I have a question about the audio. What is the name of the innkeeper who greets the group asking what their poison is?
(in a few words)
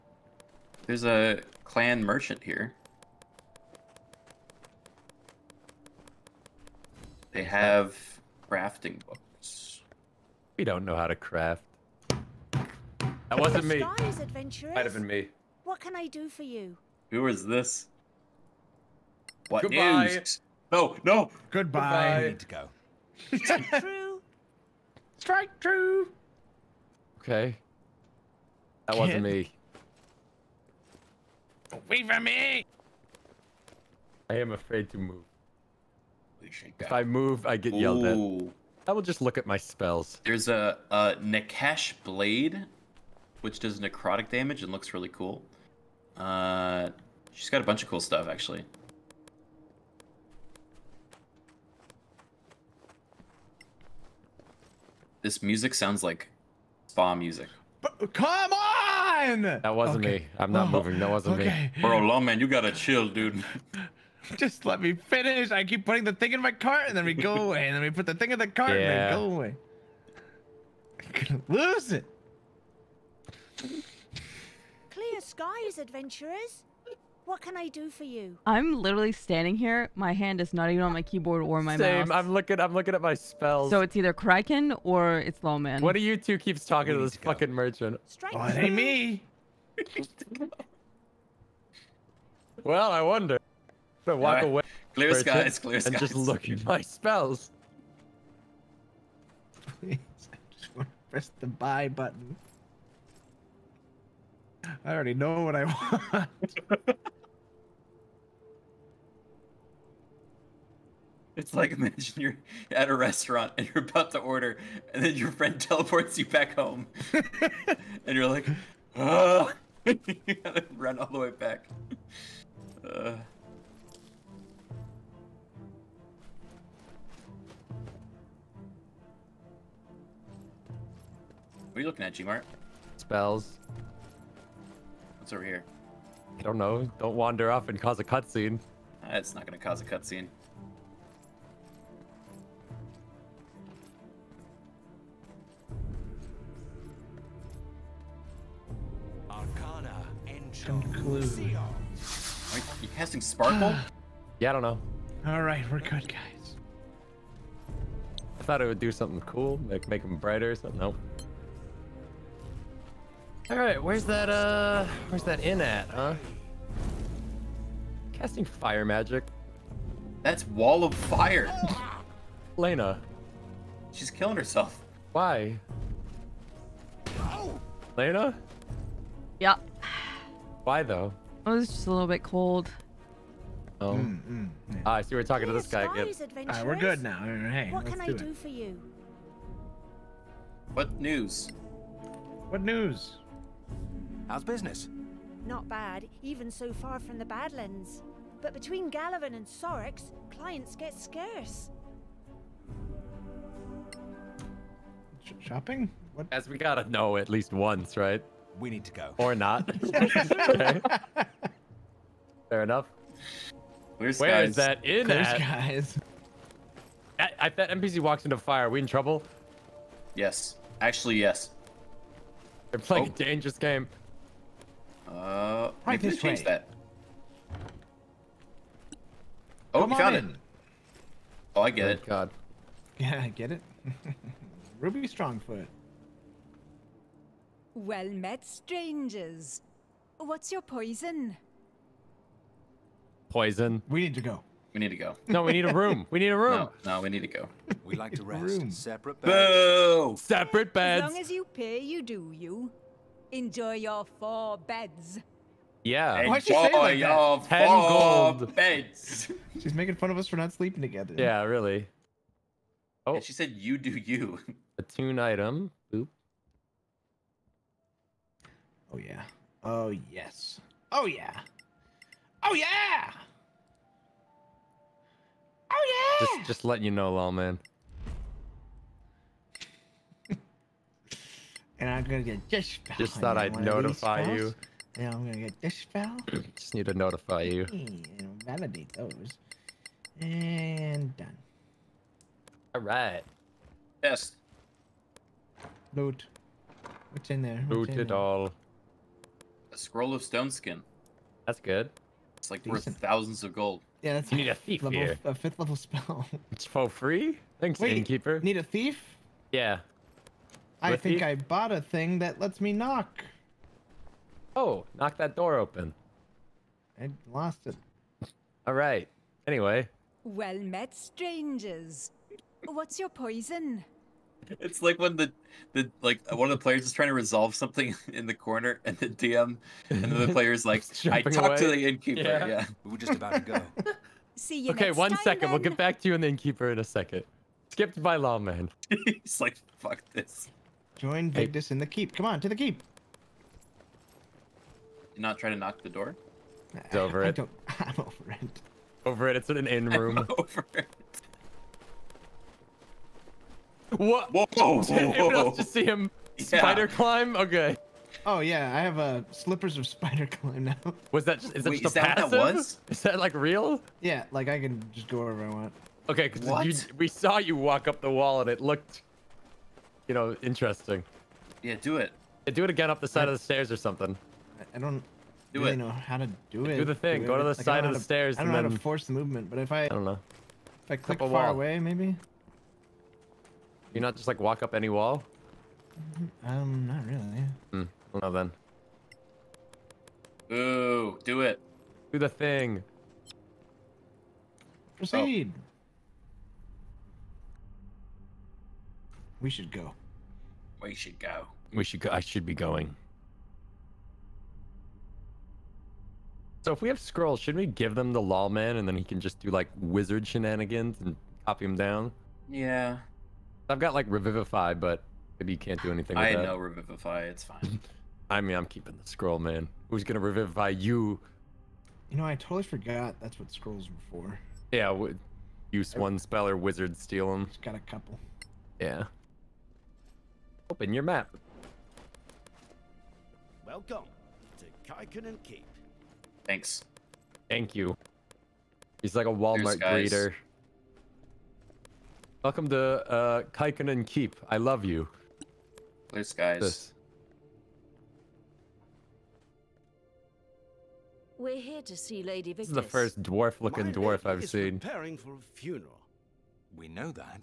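Ruby Strongfoot.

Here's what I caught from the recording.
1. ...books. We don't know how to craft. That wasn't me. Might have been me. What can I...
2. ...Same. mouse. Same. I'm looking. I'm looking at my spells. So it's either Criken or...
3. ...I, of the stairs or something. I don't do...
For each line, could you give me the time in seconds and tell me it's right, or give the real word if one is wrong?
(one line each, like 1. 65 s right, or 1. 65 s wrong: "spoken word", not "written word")
1. 9 s right
2. 81 s right
3. 373 s right.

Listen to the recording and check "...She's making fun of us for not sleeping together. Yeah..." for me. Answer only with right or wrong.
right.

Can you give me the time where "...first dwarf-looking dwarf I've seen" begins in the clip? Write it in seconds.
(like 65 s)
452 s.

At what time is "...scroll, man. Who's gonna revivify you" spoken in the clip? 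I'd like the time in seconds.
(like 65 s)
419 s.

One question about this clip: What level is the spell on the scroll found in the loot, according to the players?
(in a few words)
Fifth level.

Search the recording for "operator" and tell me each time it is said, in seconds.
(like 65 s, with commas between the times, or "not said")
not said.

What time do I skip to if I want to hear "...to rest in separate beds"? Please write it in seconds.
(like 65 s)
248 s.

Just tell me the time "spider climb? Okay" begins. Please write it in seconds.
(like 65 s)
356 s.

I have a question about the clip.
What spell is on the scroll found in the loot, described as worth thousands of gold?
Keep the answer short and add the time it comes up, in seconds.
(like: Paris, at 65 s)
Stone skin, at 300 s.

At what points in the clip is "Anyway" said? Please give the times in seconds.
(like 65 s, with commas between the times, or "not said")
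319 s.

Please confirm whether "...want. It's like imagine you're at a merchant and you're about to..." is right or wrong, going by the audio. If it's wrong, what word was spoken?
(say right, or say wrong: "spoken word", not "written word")
wrong: "restaurant", not "merchant".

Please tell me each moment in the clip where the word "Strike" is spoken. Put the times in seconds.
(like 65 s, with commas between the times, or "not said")
25 s, 88 s.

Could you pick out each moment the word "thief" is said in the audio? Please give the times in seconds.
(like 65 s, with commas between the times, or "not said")
304 s, 308 s.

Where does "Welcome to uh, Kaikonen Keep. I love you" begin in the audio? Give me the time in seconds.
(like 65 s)
442 s.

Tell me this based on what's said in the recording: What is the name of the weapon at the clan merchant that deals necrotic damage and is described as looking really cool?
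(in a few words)
Nakash Blade.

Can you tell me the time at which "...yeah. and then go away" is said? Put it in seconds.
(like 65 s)
68 s.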